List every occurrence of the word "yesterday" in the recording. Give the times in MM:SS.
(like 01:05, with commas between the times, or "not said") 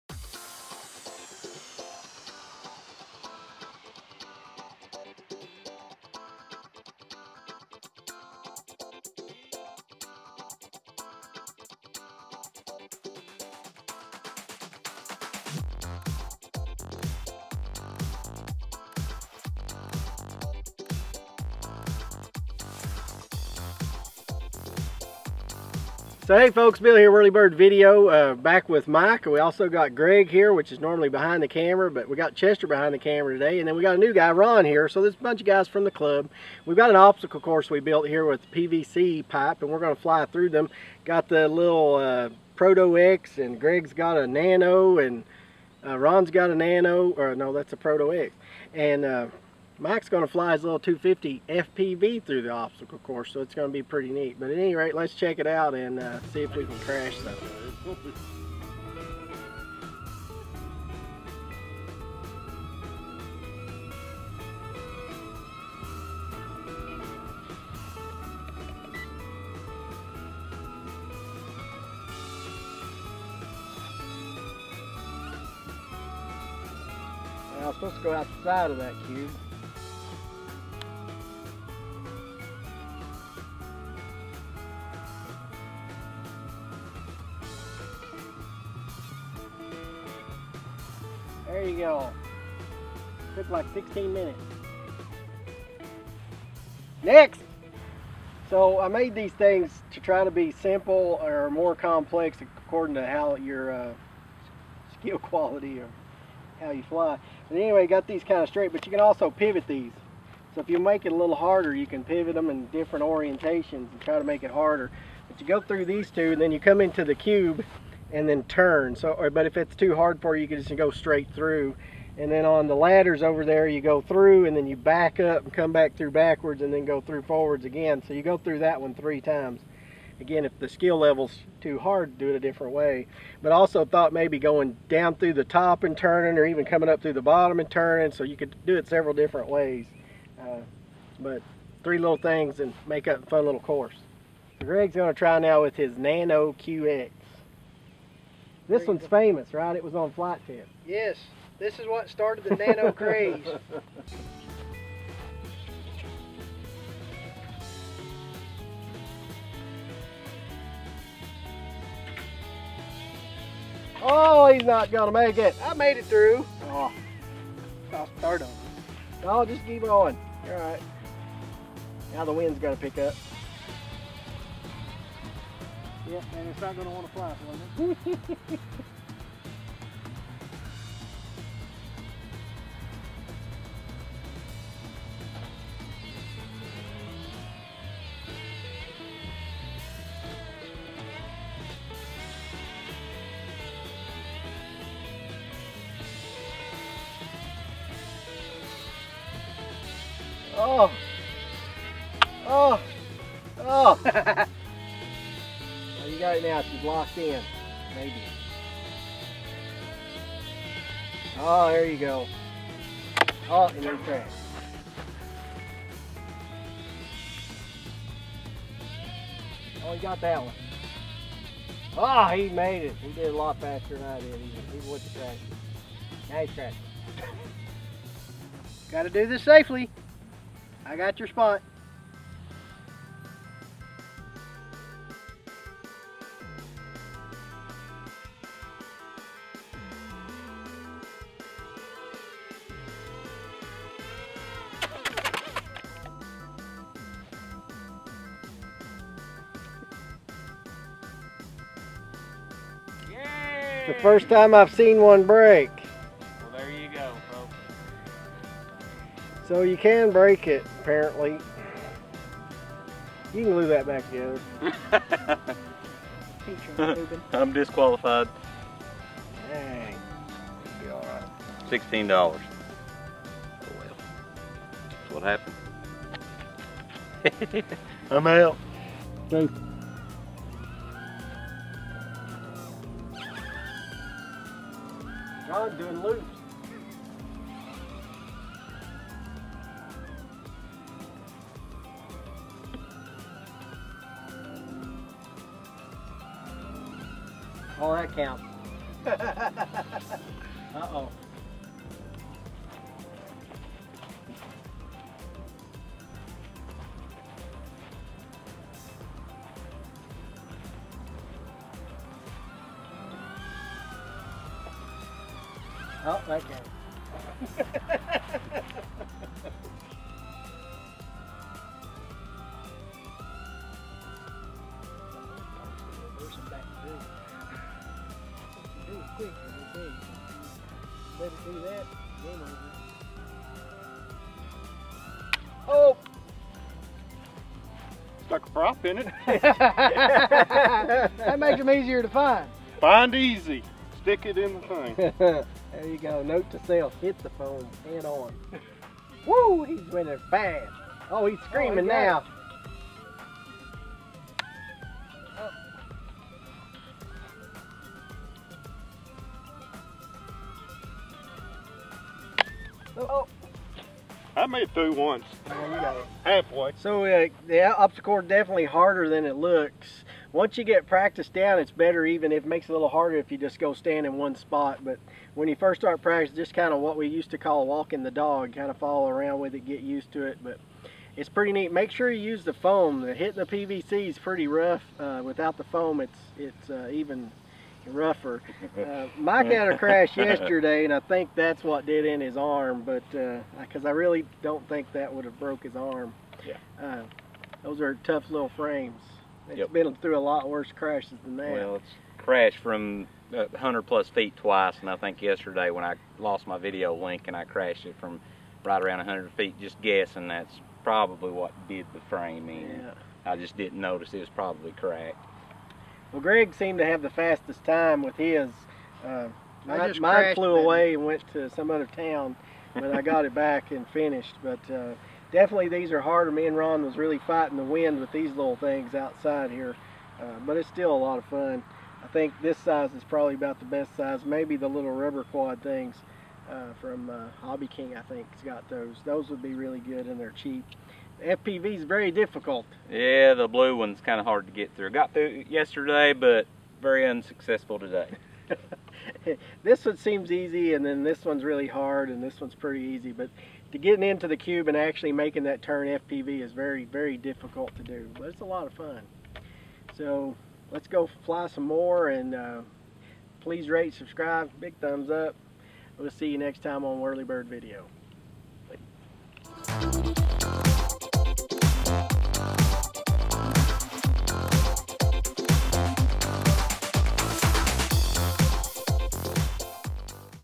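06:30, 06:45, 07:25.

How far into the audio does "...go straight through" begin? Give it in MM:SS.
02:00.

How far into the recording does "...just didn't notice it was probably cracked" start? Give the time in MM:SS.
06:53.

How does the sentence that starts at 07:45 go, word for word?
We'll see you next time on Whirlybird Video.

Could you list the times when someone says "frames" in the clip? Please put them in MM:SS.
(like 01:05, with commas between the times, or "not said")
06:38, 06:52.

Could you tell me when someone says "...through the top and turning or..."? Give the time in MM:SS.
02:15.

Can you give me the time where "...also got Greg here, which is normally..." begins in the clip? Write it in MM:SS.
00:29.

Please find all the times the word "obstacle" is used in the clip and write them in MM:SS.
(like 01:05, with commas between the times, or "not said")
00:36, 00:52, 06:07.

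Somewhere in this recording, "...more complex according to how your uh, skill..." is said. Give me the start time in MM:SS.
01:41.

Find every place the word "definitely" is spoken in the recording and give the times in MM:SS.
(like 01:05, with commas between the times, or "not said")
06:08, 07:05.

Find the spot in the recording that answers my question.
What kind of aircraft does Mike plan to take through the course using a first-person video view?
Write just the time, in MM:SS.
00:50.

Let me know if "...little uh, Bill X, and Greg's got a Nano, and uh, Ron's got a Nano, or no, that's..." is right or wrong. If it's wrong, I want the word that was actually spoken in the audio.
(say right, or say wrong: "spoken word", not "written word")
wrong: "Proto", not "Bill".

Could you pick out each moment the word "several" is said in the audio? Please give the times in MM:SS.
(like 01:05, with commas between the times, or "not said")
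02:18.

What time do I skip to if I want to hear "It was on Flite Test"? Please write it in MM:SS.
02:29.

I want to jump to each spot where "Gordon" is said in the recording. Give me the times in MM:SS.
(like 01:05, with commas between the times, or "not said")
not said.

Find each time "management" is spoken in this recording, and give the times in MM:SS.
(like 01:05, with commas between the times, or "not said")
not said.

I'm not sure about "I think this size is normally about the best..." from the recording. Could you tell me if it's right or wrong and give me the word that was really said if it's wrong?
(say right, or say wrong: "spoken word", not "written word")
wrong: "probably", not "normally".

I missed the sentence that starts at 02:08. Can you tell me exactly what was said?
So you go through that one three times.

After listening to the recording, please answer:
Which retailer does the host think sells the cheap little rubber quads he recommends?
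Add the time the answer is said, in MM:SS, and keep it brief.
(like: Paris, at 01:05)
Hobby King, at 07:17.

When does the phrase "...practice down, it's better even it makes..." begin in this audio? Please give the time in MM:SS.
06:10.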